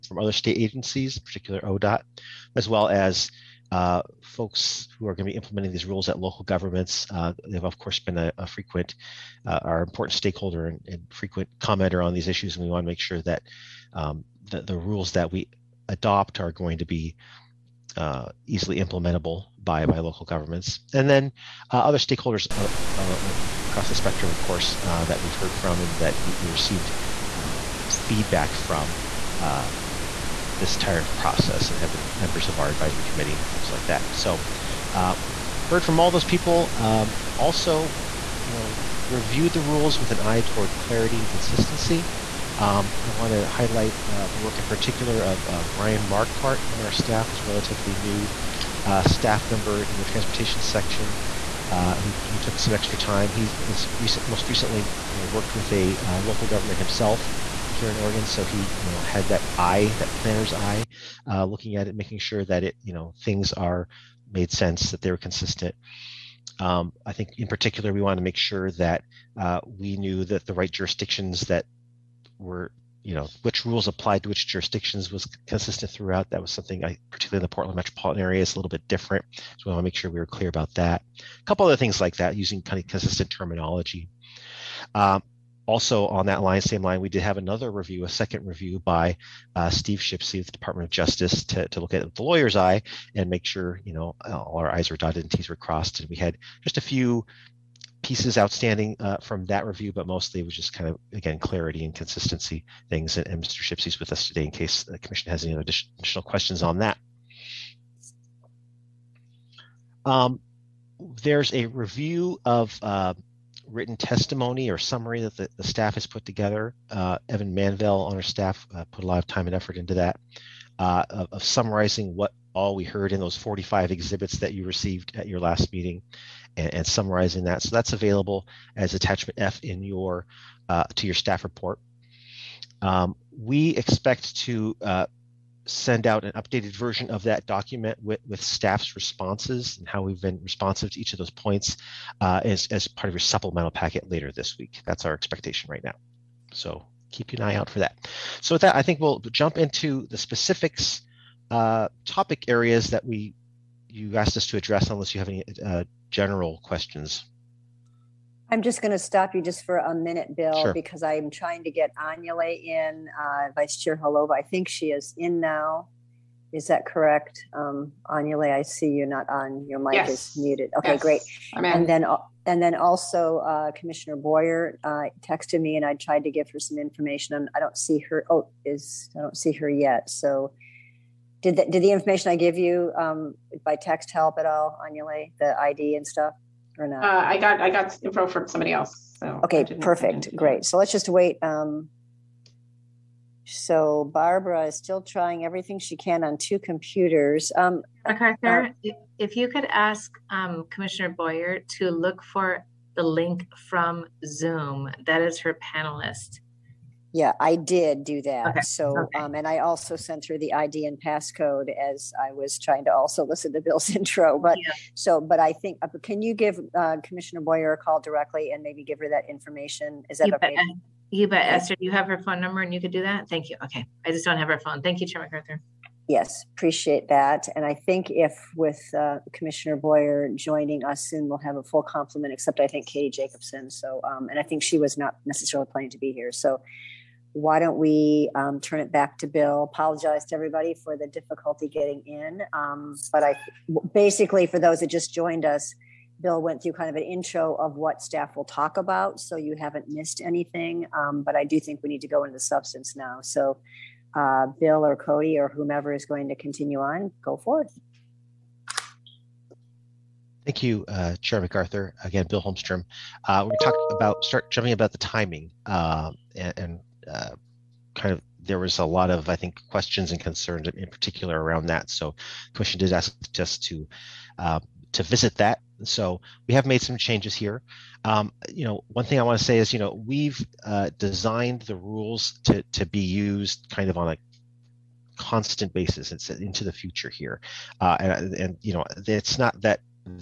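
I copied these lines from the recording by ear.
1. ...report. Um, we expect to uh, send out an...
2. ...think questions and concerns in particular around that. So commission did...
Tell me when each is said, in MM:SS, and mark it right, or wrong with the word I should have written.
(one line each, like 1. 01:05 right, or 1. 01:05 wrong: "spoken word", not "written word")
1. 02:11 right
2. 04:29 right.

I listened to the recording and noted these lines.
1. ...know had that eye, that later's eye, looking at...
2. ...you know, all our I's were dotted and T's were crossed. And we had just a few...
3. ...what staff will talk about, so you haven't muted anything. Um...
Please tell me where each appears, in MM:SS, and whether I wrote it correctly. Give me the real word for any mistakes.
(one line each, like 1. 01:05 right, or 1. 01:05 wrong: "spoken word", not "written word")
1. 00:58 wrong: "planner", not "later"
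2. 01:33 right
3. 04:07 wrong: "missed", not "muted".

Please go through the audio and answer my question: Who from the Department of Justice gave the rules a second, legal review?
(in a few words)
Steve Shipsey.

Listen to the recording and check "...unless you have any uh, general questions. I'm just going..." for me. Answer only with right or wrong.
right.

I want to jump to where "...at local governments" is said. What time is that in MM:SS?
00:06.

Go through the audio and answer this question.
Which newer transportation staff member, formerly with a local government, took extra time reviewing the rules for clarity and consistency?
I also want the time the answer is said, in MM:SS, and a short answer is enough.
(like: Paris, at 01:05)
Ryan Markhart, at 00:45.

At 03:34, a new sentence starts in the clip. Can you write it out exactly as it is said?
so, but I think, uh, can you give uh, Commissioner Boyer a call directly and maybe give her that information?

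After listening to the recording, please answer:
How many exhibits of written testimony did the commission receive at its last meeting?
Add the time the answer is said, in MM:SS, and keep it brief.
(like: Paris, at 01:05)
45, at 02:03.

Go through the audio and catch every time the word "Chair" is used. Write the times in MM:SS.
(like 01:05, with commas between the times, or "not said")
02:43, 03:45, 04:21.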